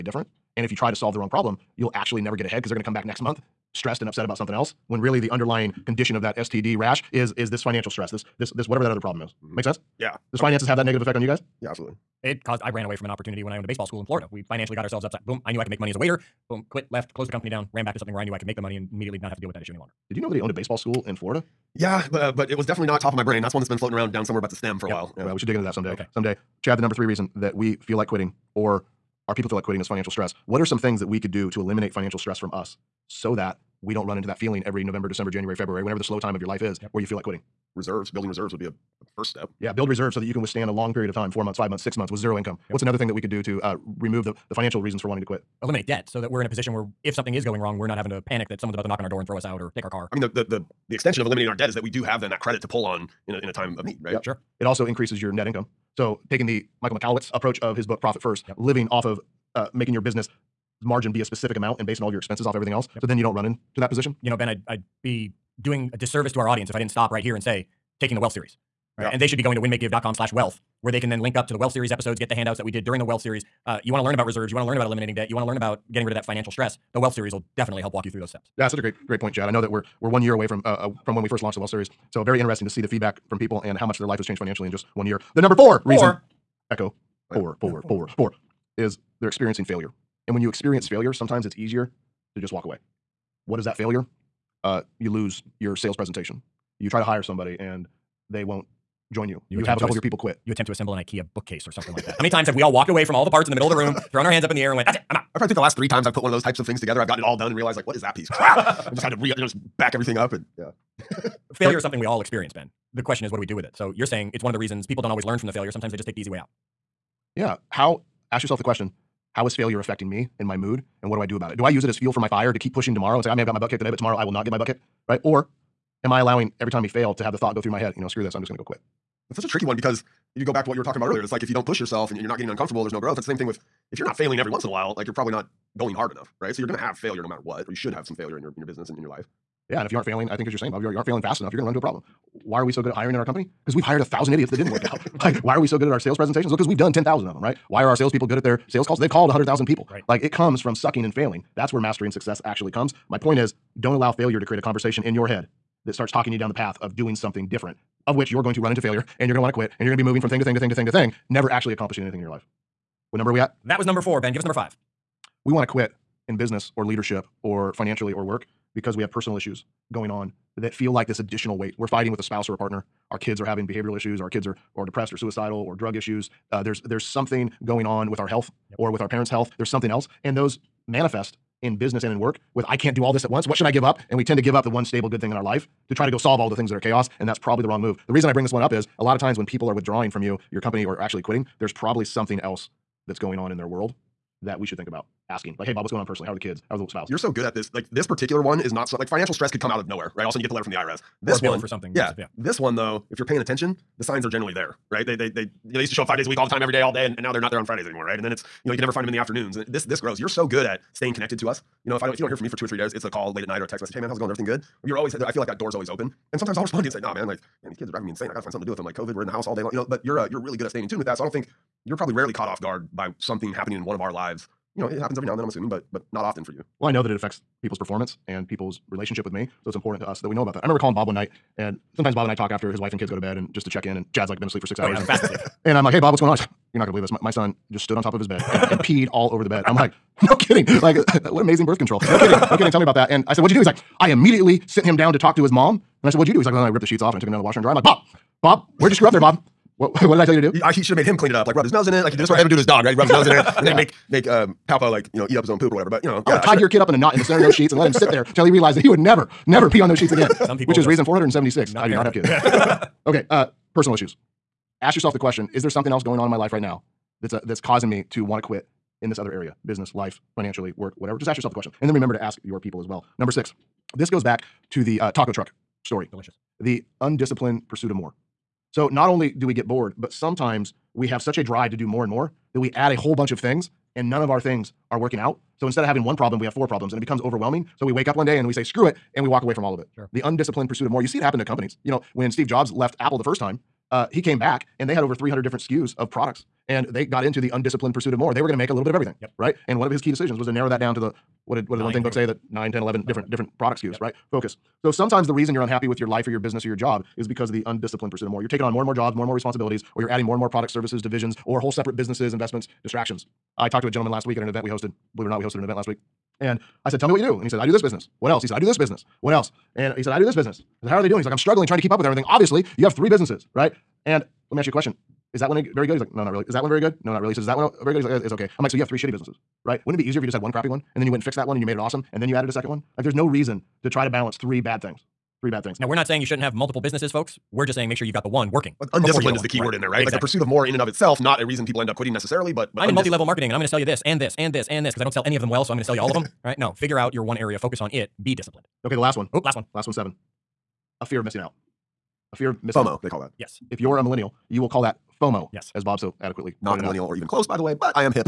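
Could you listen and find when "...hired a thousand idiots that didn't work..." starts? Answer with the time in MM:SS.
02:23.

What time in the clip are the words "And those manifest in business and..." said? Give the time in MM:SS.
03:00.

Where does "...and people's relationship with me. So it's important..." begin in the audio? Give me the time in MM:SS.
03:48.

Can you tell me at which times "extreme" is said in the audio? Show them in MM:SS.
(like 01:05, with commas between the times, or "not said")
not said.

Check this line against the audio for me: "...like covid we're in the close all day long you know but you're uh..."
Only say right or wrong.
wrong.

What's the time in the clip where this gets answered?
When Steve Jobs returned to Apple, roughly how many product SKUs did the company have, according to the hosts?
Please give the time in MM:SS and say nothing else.
04:55.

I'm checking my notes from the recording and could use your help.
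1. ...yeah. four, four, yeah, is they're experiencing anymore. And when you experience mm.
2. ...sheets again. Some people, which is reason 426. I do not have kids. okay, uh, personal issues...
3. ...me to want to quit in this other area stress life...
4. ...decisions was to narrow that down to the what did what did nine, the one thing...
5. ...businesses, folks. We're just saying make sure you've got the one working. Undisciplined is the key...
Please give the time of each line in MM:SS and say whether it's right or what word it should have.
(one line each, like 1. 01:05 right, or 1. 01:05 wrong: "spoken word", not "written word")
1. 01:27 wrong: "failure", not "anymore"
2. 04:19 wrong: "476", not "426"
3. 04:27 wrong: "business", not "stress"
4. 05:00 right
5. 05:36 right.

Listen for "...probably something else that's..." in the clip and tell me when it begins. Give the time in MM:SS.
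03:11.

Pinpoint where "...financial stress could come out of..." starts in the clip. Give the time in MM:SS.
03:19.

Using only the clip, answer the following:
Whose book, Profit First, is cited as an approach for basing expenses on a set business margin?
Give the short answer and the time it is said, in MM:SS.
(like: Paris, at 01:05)
Michael Michalowicz, at 00:56.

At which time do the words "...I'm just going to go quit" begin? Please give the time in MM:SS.
02:08.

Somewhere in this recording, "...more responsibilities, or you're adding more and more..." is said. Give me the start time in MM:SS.
05:09.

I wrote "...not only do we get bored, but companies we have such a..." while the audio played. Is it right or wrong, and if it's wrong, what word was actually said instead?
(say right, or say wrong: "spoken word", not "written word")
wrong: "sometimes", not "companies".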